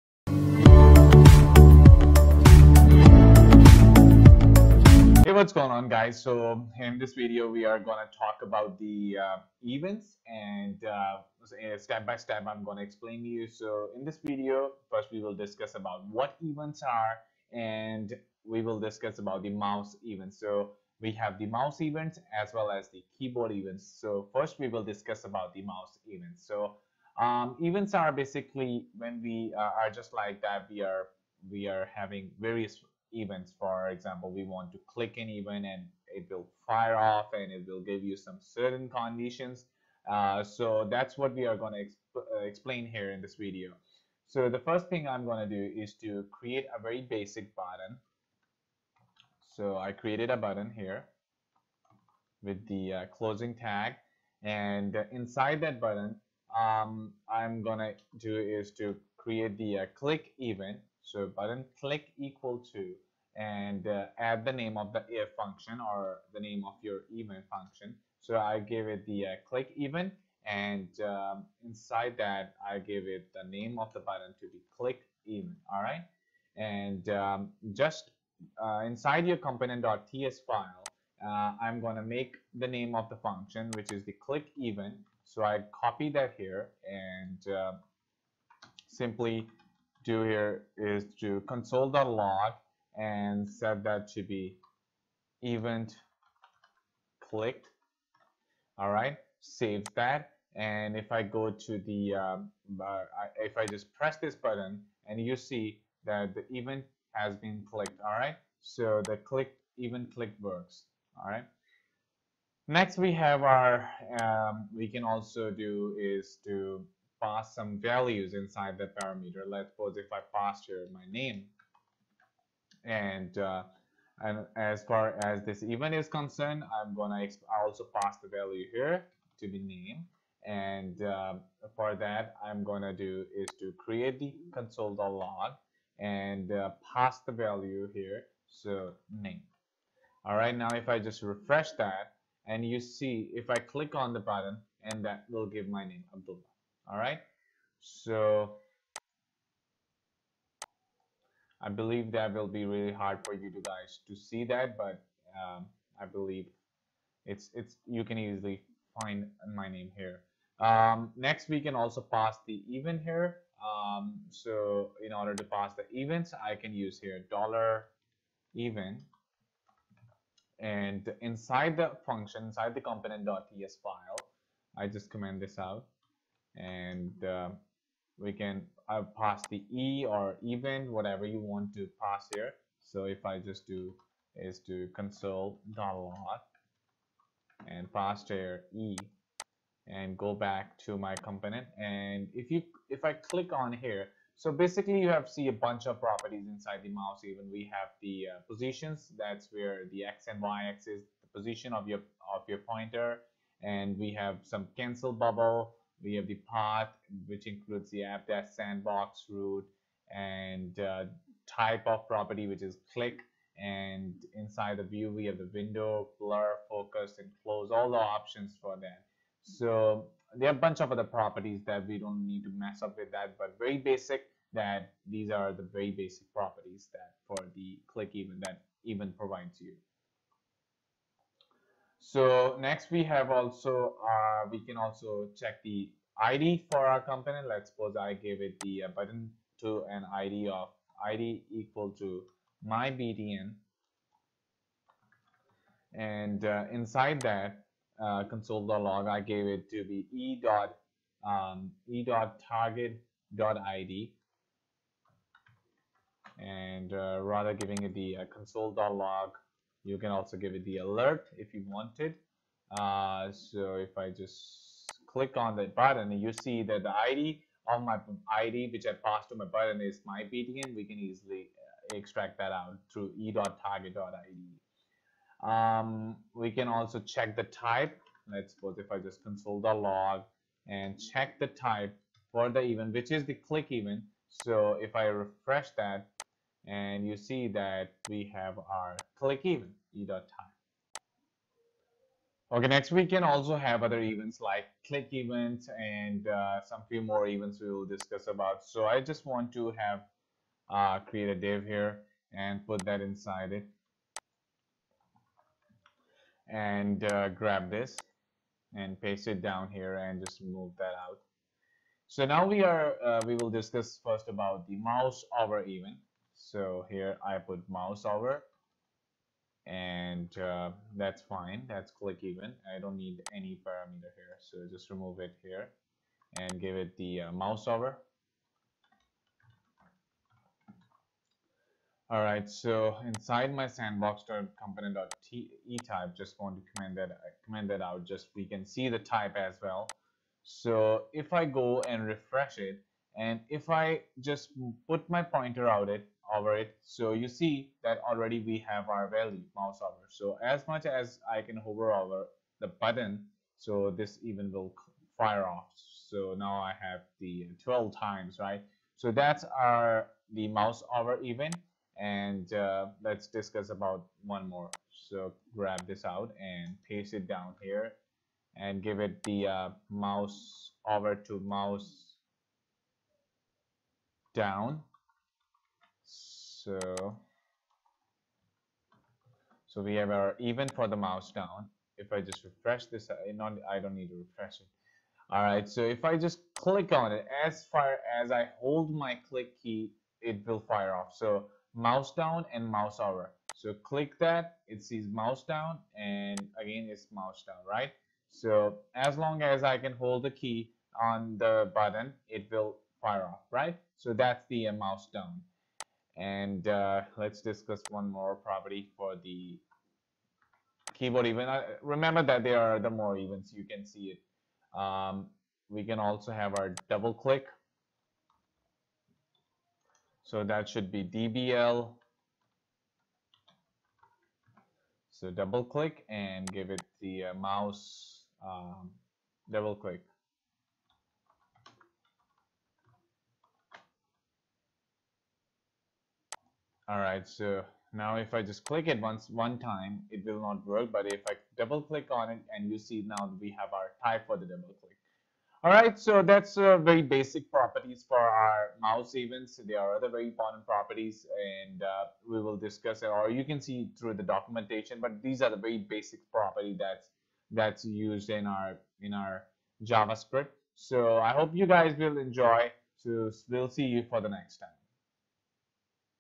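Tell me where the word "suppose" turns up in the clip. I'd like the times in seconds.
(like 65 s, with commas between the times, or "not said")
119 s, 237 s, 278 s.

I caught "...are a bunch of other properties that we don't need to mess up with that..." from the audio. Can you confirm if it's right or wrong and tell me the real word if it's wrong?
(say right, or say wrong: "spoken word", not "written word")
right.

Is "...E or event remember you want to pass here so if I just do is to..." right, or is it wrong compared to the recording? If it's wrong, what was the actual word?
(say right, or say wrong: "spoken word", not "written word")
wrong: "whatever", not "remember".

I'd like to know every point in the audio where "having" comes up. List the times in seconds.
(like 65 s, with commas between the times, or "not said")
31 s.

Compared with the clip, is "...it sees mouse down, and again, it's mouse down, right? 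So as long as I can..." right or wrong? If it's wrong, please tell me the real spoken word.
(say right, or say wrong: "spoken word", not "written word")
right.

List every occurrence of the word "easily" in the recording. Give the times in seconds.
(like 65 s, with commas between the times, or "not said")
158 s, 270 s.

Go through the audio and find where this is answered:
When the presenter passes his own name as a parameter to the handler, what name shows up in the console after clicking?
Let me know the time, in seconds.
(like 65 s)
146 s.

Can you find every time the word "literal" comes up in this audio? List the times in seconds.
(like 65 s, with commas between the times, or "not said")
not said.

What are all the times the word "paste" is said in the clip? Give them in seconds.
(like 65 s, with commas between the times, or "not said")
309 s, 366 s.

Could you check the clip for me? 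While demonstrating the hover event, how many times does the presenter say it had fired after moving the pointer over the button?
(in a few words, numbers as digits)
12 times.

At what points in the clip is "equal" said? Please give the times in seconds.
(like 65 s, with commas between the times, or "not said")
62 s, 241 s.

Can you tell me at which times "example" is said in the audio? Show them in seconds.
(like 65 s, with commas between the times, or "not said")
33 s.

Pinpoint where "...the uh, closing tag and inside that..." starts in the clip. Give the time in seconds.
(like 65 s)
52 s.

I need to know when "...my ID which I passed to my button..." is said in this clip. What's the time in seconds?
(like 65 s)
267 s.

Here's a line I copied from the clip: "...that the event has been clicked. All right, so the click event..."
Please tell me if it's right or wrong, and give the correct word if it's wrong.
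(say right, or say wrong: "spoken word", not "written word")
right.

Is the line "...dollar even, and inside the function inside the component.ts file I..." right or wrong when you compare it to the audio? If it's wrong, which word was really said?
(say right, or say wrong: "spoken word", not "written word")
right.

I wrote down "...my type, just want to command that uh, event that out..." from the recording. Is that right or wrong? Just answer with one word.
wrong.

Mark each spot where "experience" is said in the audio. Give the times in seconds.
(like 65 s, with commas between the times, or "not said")
not said.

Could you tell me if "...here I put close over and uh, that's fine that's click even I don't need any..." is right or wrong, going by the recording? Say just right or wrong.
wrong.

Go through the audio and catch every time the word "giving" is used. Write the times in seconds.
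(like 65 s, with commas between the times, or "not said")
257 s.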